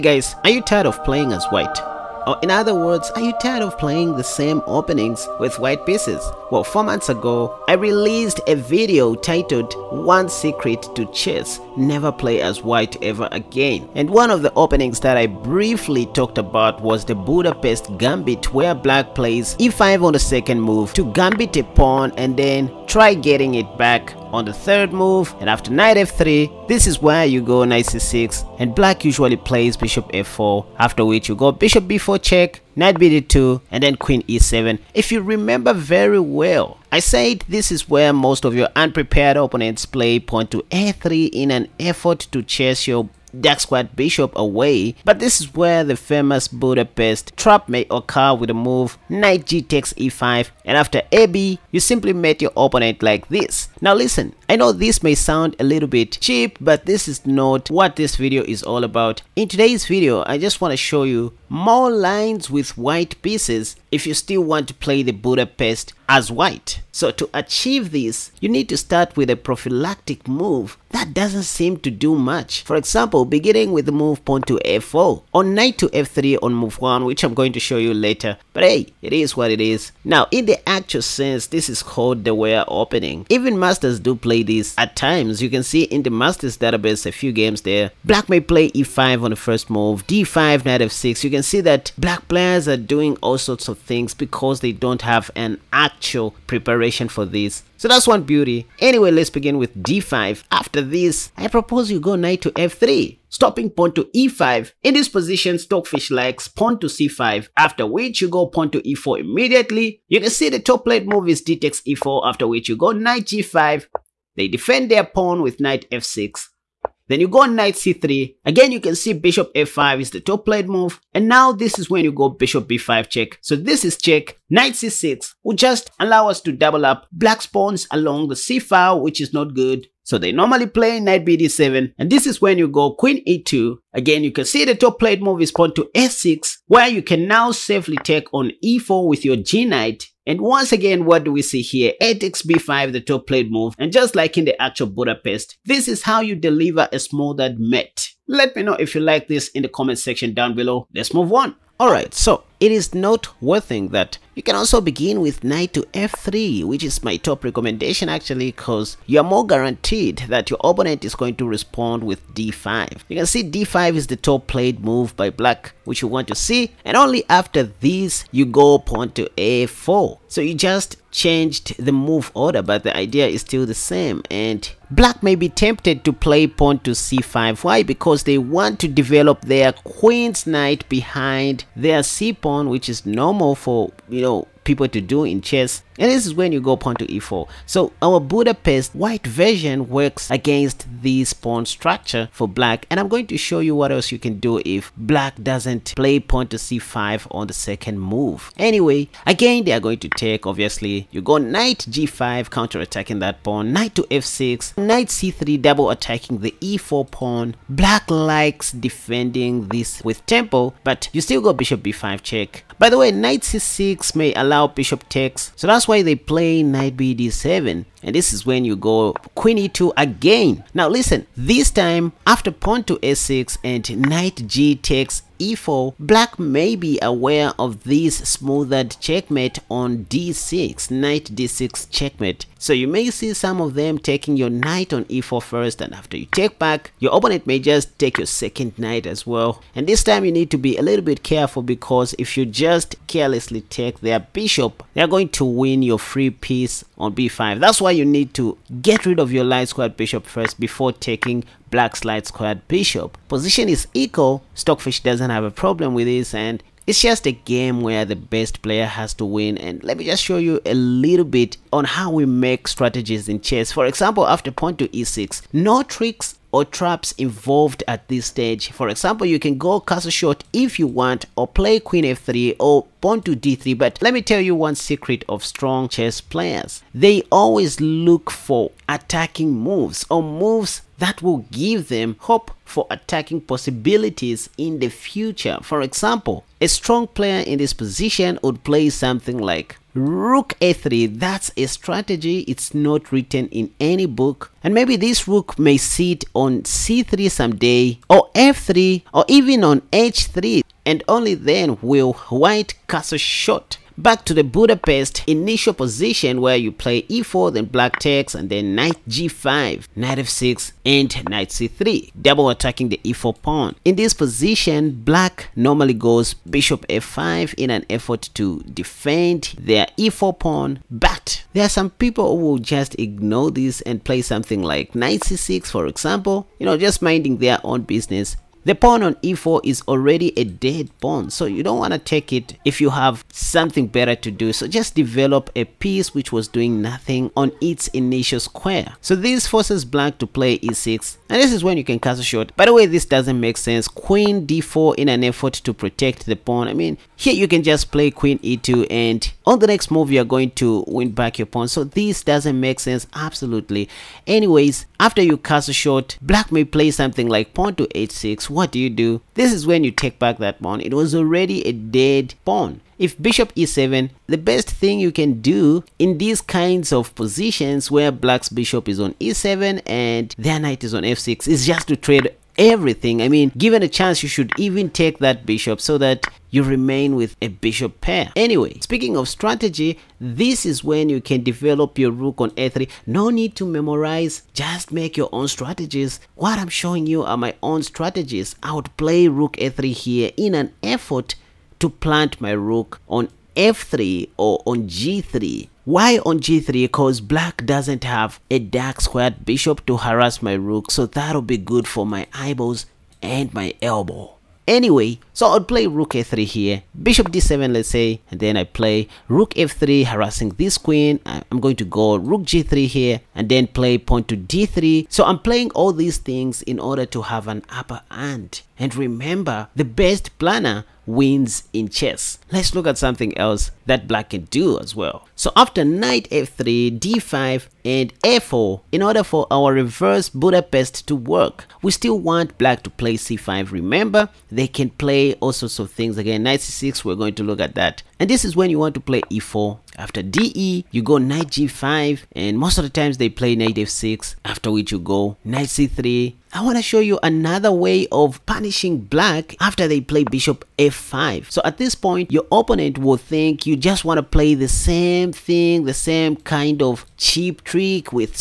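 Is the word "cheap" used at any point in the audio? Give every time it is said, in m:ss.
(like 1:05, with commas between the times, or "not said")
0:56, 7:37.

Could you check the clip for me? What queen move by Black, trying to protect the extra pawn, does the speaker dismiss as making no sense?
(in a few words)
Queen d4.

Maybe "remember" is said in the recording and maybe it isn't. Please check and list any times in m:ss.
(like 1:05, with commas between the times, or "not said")
0:35, 6:58, 7:13.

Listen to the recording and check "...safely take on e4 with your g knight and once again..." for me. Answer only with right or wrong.
right.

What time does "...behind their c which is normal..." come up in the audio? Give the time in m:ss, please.
3:00.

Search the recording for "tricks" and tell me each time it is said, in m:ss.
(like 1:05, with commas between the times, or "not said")
4:25, 7:37.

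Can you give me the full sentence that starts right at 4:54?
And maybe this rook may sit on c3 someday, or f3, or even on h3.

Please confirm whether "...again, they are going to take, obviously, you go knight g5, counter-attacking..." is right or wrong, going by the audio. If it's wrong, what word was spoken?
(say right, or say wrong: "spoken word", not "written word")
right.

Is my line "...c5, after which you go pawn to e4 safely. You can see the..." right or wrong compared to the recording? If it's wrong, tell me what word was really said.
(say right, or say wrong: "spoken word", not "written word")
wrong: "immediately", not "safely".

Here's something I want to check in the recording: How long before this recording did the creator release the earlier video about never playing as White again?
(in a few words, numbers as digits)
4 months.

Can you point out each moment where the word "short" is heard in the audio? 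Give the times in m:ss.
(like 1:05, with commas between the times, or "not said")
4:30, 5:03, 5:42, 5:55.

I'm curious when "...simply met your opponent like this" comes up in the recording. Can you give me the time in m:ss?
0:51.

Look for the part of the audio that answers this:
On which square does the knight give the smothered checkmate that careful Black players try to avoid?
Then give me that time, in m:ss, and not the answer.
3:50.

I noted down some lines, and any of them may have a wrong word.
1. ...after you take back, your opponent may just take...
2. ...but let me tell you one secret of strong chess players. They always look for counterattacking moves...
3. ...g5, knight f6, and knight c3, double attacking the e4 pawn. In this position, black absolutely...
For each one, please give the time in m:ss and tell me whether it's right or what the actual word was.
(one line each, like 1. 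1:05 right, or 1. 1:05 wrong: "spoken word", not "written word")
1. 3:55 right
2. 4:33 wrong: "attacking", not "counterattacking"
3. 5:09 wrong: "normally", not "absolutely".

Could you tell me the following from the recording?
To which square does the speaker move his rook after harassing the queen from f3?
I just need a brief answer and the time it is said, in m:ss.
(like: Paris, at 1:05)
g3, at 6:52.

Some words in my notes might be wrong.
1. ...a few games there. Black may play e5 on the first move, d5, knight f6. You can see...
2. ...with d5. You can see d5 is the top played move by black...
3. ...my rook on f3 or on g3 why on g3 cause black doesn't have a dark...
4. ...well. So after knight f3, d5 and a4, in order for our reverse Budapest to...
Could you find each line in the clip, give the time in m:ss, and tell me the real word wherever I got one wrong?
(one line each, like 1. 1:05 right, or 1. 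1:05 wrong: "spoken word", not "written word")
1. 1:27 right
2. 2:42 right
3. 6:32 right
4. 7:04 right.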